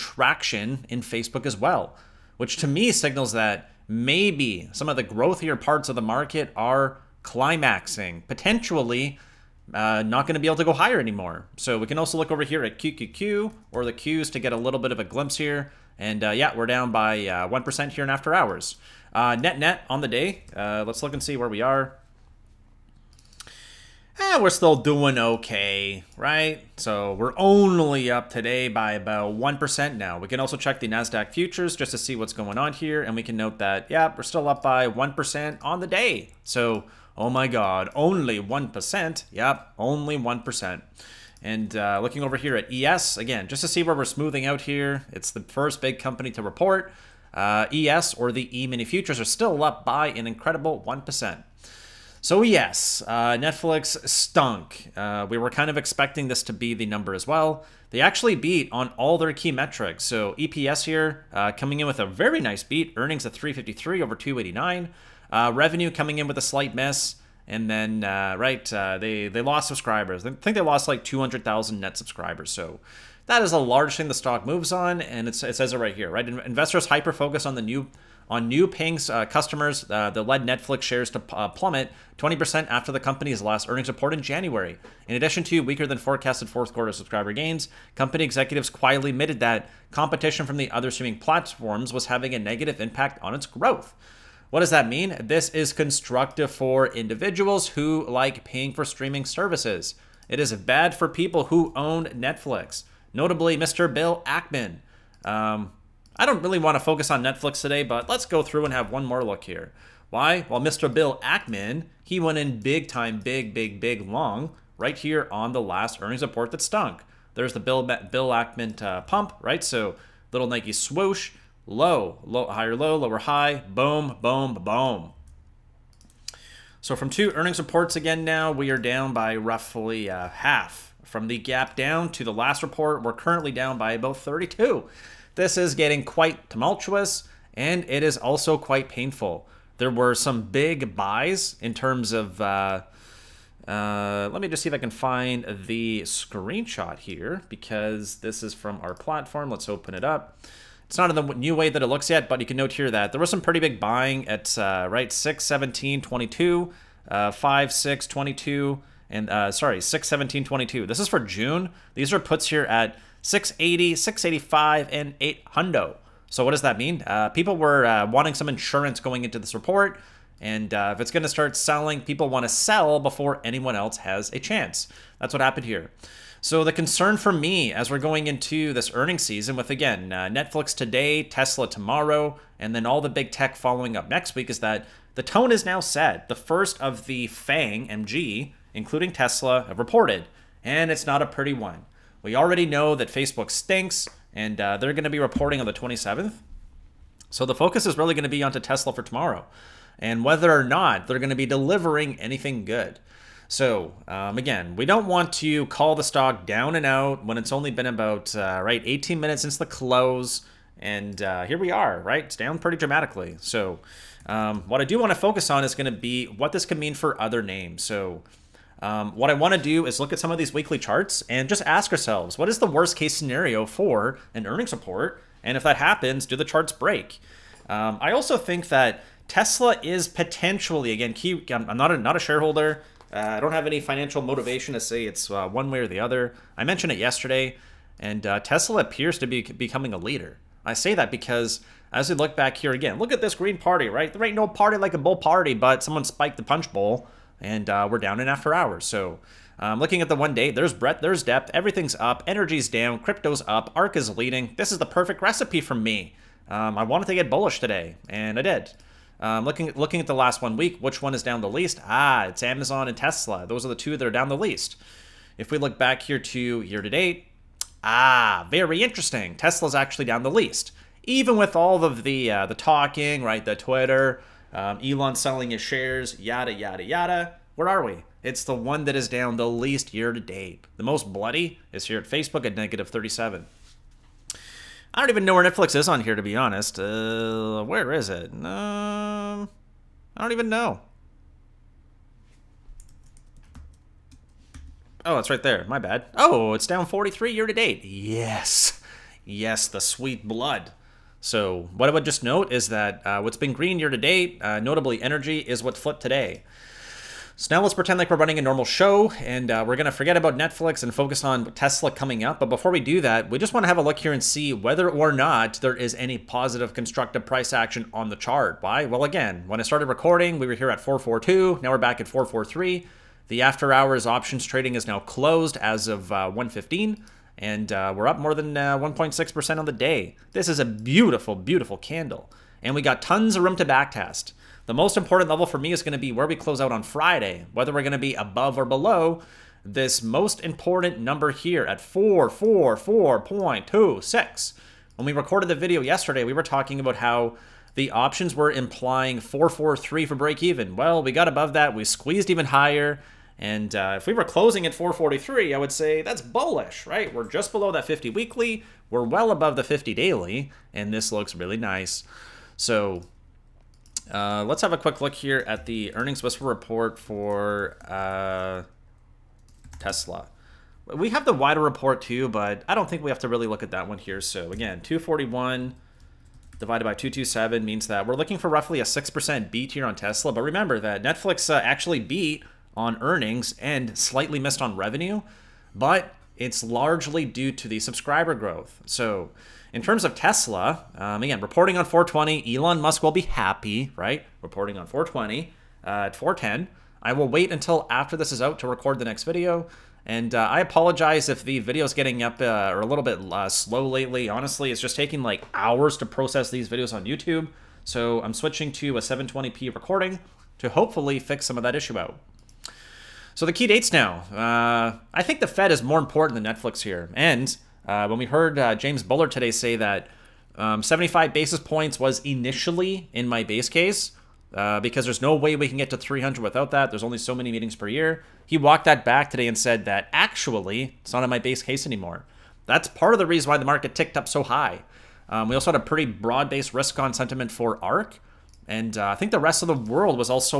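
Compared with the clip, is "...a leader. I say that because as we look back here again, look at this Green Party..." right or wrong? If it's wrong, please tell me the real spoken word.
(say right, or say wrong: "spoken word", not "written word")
right.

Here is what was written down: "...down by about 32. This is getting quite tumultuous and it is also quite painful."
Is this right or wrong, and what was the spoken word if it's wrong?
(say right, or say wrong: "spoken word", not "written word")
right.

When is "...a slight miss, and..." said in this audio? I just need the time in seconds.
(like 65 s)
66 s.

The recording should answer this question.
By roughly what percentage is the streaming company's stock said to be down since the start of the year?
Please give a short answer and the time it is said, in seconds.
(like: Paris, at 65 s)
43%, at 296 s.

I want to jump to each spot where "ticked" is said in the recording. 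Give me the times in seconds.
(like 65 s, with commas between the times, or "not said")
433 s.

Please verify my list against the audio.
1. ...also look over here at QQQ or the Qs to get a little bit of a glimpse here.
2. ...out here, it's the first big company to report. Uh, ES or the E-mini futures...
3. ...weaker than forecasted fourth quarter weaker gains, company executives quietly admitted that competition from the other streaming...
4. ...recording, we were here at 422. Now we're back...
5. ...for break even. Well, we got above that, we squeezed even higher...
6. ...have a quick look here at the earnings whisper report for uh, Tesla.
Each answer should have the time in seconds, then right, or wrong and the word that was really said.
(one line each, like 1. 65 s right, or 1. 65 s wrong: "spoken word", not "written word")
1. 11 s right
2. 44 s right
3. 85 s wrong: "subscriber", not "weaker"
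4. 319 s wrong: "442", not "422"
5. 350 s right
6. 364 s right.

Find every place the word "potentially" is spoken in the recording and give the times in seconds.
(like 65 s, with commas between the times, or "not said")
8 s, 230 s.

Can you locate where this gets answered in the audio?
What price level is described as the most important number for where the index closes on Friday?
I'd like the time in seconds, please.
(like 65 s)
341 s.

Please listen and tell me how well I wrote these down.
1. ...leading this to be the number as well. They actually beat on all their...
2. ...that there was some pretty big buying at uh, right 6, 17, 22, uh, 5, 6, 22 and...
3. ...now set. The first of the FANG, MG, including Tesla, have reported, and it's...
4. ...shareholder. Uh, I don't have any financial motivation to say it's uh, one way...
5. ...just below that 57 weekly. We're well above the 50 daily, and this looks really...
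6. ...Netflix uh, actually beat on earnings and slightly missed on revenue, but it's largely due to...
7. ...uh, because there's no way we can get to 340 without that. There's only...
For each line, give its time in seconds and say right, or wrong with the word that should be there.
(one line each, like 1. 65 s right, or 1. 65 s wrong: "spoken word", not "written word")
1. 55 s wrong: "expecting", not "leading"
2. 152 s right
3. 185 s right
4. 232 s right
5. 357 s wrong: "50", not "57"
6. 381 s right
7. 424 s wrong: "300", not "340".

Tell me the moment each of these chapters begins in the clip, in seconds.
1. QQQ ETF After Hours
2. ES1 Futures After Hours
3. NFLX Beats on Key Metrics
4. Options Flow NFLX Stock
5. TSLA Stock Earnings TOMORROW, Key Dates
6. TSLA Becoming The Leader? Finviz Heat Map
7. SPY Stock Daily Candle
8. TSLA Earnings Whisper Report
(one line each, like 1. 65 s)
1. 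13 s
2. 43 s
3. 58 s
4. 153 s
5. 178 s
6. 233 s
7. 323 s
8. 368 s.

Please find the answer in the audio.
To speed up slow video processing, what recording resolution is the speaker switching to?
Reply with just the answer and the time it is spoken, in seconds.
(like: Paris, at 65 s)
720p, at 409 s.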